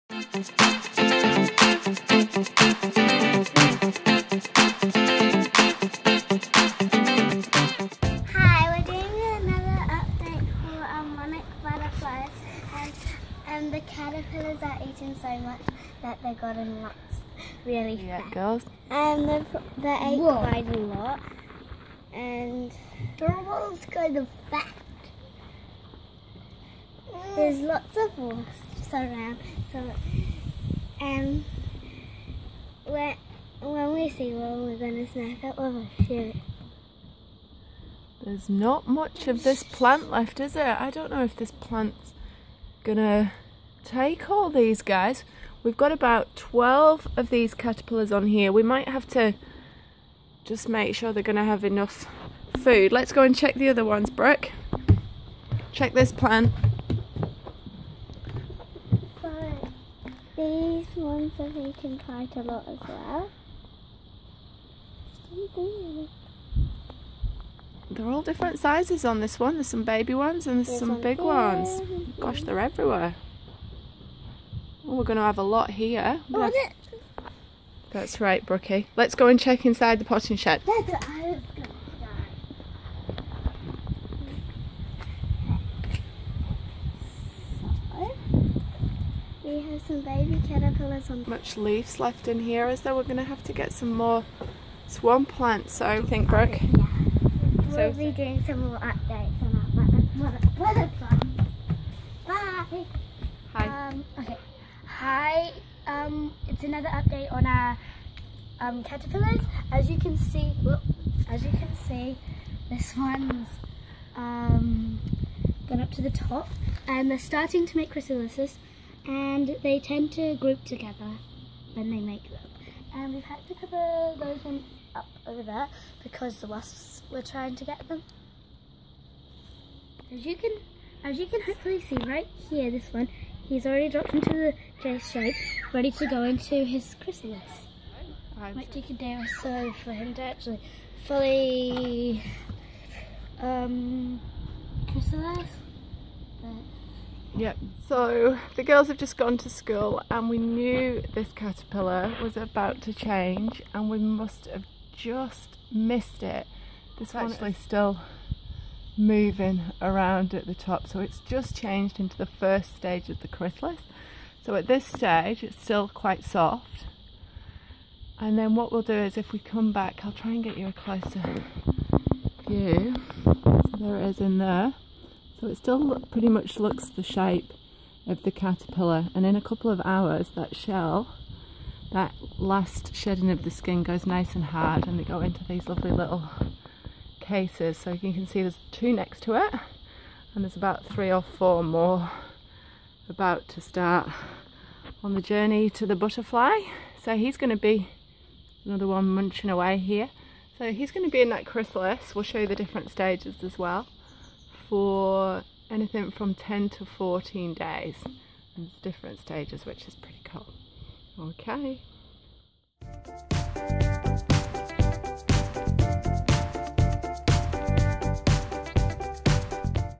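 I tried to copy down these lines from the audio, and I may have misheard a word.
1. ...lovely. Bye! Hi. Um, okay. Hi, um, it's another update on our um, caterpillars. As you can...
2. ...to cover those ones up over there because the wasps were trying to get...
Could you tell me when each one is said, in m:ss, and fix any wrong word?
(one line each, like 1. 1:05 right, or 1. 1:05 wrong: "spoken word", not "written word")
1. 1:40 wrong: "butterfly", not "lovely"
2. 2:03 right.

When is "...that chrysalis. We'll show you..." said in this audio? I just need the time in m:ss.
3:21.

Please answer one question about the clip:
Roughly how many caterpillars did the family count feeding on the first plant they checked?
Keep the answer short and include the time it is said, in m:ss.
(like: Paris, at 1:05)
12, at 0:45.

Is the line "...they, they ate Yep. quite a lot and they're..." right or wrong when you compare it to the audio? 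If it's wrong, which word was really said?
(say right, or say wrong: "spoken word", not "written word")
wrong: "Whoa", not "Yep".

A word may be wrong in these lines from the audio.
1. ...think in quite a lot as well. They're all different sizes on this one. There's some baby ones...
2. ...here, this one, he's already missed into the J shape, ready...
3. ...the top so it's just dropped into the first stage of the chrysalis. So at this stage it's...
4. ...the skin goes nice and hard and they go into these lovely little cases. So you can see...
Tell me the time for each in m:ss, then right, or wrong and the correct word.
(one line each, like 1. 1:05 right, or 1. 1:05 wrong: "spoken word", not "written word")
1. 1:01 right
2. 2:12 wrong: "dropped", not "missed"
3. 2:40 wrong: "changed", not "dropped"
4. 3:03 right.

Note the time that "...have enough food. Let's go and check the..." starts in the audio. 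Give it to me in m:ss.
0:51.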